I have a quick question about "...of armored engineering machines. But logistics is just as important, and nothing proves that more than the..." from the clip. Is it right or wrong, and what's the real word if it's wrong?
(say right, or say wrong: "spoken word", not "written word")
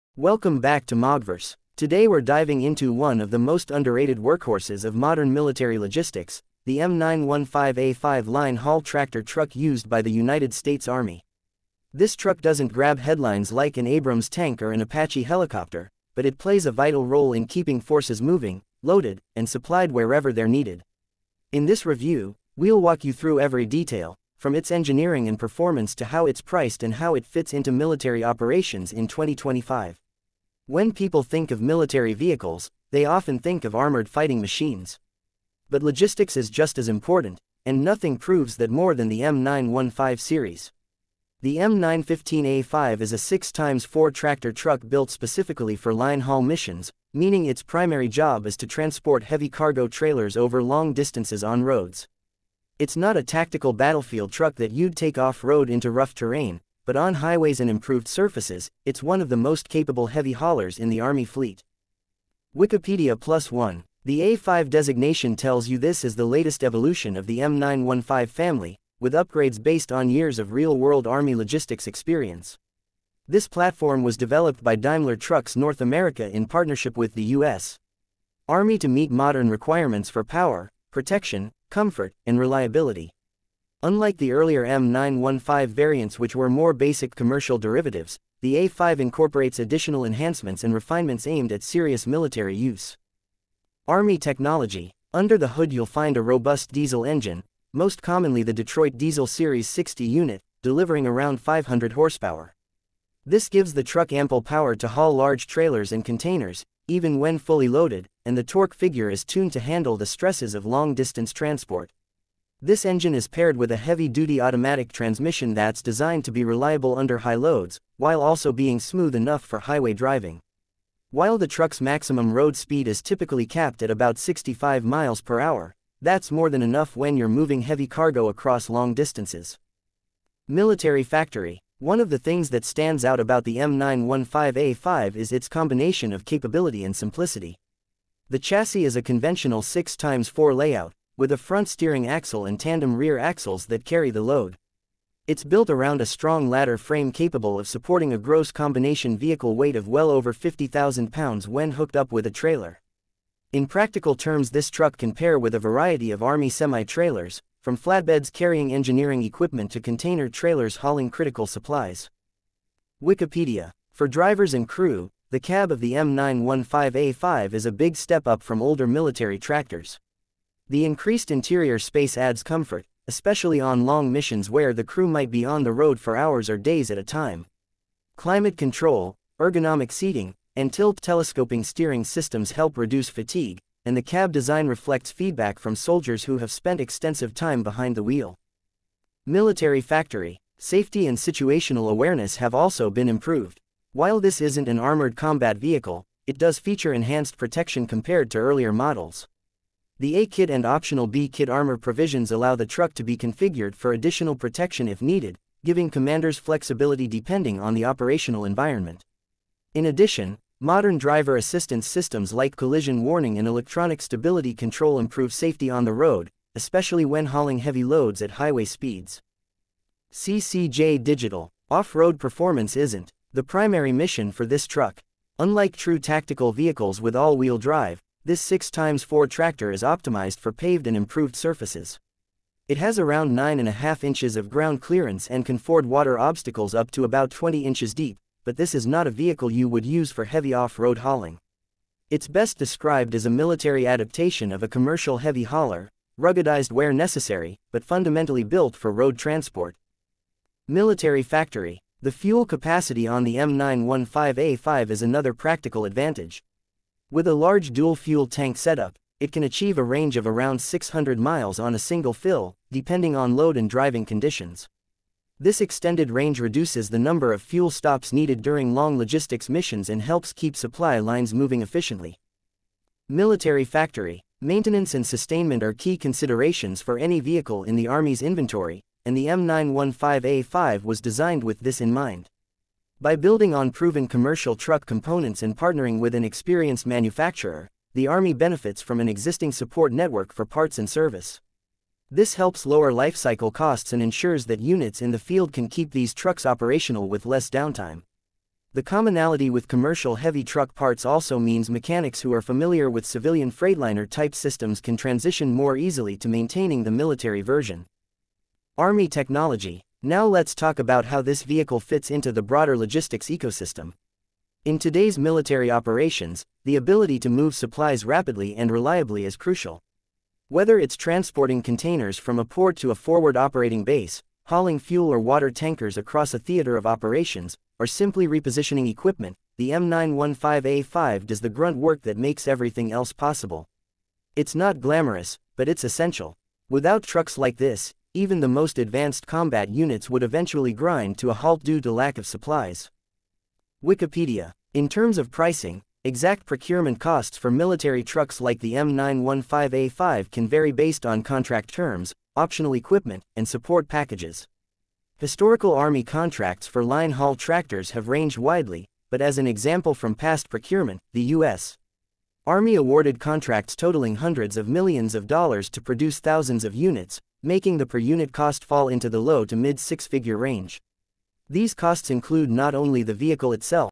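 wrong: "fighting", not "engineering".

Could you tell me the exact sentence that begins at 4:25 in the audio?
This extended range reduces the number of fuel stops needed during long logistics missions and helps keep supply lines moving efficiently.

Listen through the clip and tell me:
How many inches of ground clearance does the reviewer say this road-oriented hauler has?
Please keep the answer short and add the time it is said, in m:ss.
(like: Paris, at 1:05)
9.5, at 3:53.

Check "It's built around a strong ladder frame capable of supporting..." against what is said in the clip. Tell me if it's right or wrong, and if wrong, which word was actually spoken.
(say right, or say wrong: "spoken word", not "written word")
right.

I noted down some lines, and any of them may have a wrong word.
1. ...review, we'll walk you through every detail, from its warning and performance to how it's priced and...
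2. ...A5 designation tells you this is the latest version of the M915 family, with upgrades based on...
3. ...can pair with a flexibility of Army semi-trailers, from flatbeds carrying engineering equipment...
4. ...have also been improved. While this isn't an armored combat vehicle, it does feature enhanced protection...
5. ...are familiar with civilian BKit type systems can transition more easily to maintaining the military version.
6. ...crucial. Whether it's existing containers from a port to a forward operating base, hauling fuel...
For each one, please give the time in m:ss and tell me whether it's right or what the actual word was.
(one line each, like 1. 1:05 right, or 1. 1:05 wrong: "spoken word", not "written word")
1. 0:21 wrong: "engineering", not "warning"
2. 1:04 wrong: "evolution", not "version"
3. 2:34 wrong: "variety", not "flexibility"
4. 3:12 right
5. 5:02 wrong: "Freightliner", not "BKit"
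6. 5:19 wrong: "transporting", not "existing".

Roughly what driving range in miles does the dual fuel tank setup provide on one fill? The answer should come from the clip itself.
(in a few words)
600.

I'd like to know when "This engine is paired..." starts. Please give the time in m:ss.
1:52.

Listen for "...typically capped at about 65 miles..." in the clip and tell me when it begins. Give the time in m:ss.
2:03.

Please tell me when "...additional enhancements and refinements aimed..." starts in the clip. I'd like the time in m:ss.
1:29.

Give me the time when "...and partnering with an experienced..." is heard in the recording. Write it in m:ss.
4:45.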